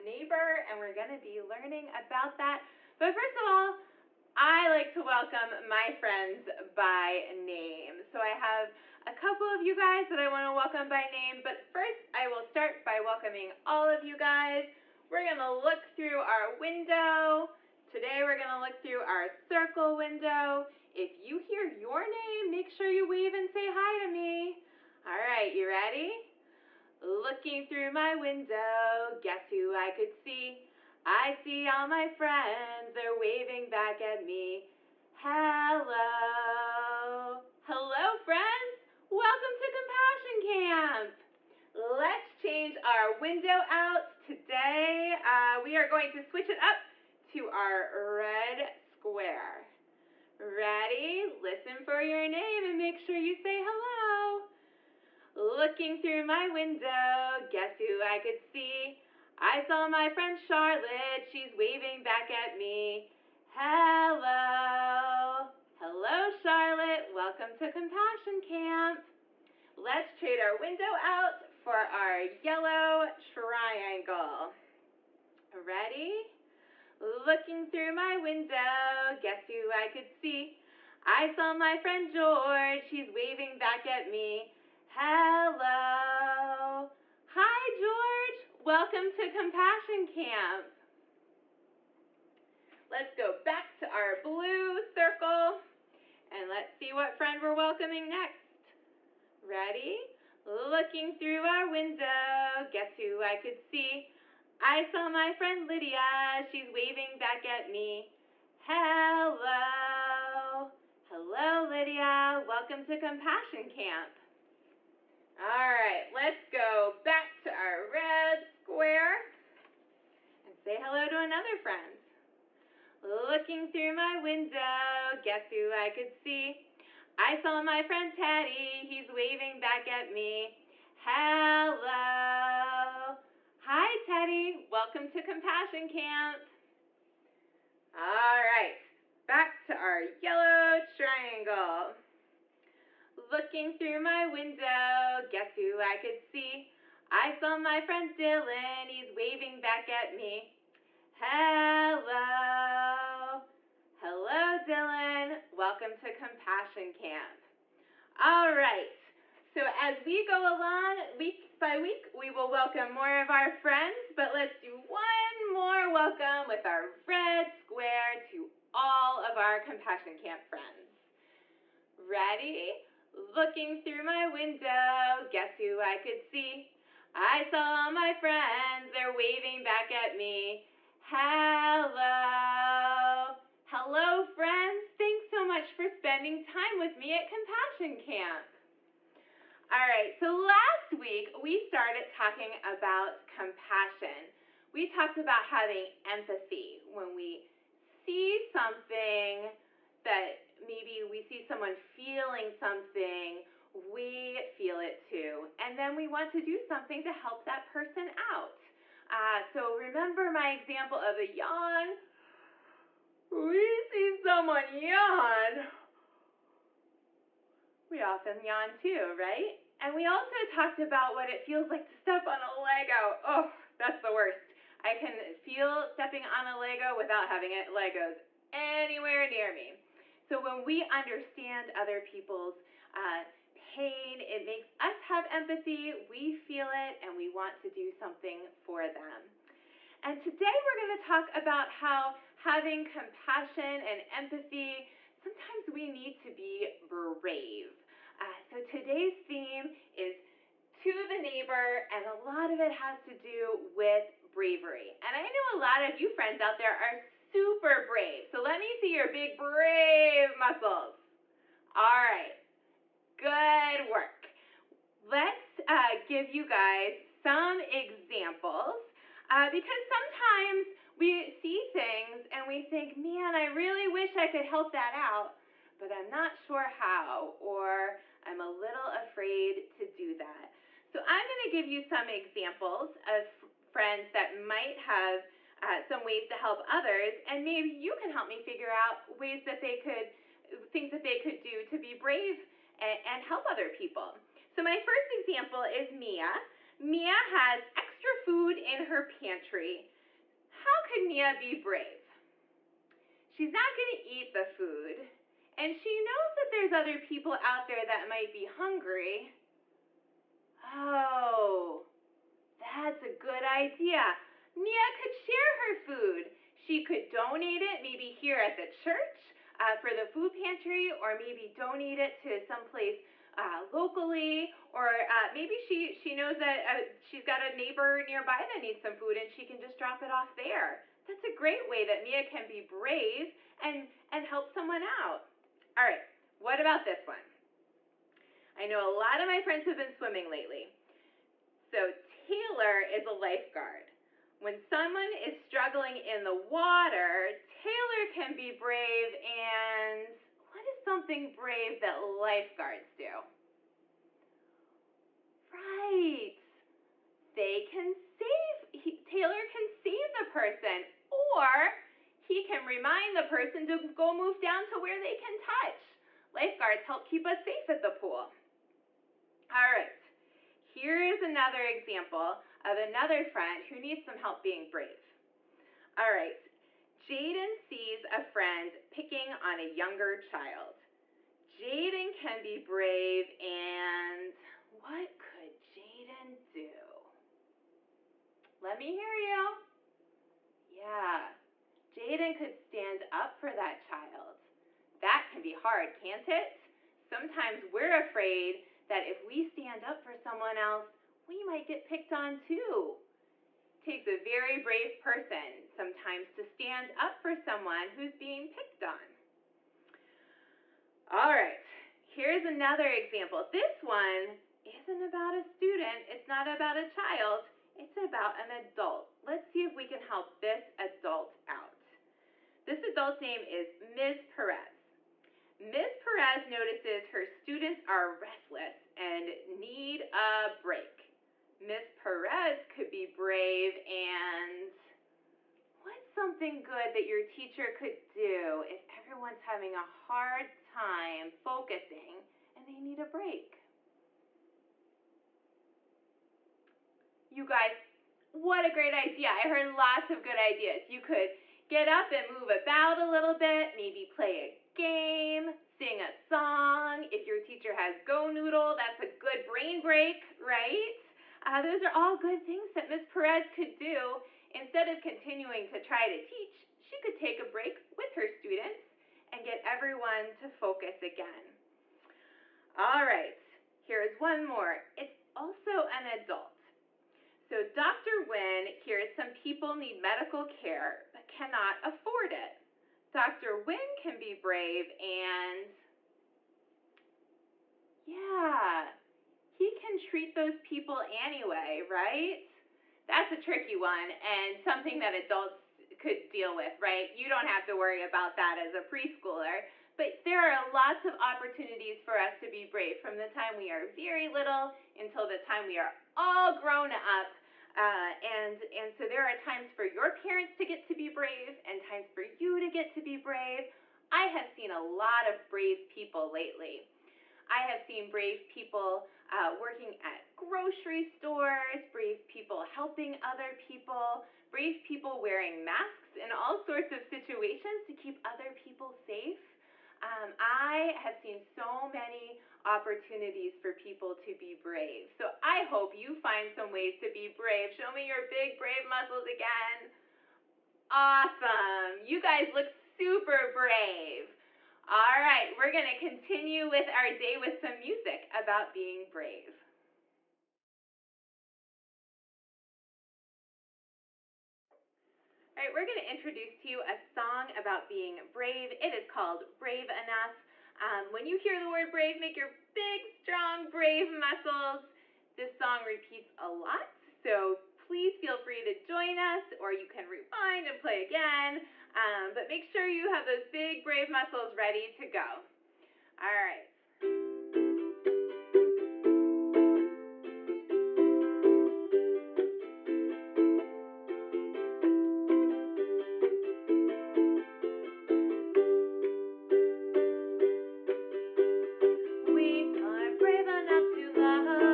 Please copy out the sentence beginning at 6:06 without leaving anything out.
Lifeguards help keep us safe at the pool.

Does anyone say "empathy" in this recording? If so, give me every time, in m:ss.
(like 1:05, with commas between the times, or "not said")
3:16, 3:55, 4:04.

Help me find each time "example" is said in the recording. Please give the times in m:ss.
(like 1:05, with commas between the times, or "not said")
3:30, 4:27, 4:42, 4:55, 6:11, 6:52.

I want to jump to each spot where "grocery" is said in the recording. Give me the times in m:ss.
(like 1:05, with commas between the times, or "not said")
8:40.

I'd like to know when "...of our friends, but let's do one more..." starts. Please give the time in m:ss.
2:43.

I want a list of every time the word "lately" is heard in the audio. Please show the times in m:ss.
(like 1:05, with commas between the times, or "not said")
5:40, 8:36.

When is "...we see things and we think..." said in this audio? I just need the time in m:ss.
4:30.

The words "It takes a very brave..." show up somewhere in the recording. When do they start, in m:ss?
6:43.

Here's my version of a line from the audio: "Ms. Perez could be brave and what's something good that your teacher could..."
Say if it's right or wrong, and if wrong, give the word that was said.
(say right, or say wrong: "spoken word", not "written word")
right.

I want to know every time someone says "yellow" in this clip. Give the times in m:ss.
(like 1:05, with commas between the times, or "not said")
1:12, 2:20.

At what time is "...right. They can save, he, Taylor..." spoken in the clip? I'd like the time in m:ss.
5:55.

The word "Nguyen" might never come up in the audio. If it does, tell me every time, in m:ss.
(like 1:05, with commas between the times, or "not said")
7:58, 8:03.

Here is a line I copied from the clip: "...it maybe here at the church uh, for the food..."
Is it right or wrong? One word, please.
right.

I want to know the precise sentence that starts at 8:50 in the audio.
Um, I have seen so many opportunities for people to be brave.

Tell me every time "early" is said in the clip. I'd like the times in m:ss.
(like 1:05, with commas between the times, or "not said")
not said.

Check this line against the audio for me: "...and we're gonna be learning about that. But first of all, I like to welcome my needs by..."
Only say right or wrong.
wrong.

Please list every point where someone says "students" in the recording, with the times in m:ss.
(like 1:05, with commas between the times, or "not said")
6:55, 7:07, 7:48.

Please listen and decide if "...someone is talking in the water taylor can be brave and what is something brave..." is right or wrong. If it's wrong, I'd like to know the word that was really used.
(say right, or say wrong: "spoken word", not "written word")
wrong: "struggling", not "talking".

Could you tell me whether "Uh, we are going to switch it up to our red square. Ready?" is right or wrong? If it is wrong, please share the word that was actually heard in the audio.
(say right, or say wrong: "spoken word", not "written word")
right.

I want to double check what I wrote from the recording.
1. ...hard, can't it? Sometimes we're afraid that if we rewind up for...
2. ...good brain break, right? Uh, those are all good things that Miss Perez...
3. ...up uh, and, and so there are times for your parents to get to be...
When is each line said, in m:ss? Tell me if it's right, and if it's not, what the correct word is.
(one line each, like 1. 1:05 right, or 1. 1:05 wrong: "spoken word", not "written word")
1. 6:35 wrong: "stand", not "rewind"
2. 7:39 right
3. 8:26 right.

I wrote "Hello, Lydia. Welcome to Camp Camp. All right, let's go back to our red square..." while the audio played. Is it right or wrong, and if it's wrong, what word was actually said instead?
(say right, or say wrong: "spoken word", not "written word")
wrong: "Compassion", not "Camp".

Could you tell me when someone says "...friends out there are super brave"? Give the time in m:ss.
4:16.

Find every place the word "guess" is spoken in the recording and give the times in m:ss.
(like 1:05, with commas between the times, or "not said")
0:29, 0:57, 1:19, 1:42, 2:05, 2:25, 2:55.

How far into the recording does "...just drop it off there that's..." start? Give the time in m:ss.
5:29.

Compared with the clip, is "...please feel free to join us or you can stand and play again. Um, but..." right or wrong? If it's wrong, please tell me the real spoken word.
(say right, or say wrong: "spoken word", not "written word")
wrong: "rewind", not "stand".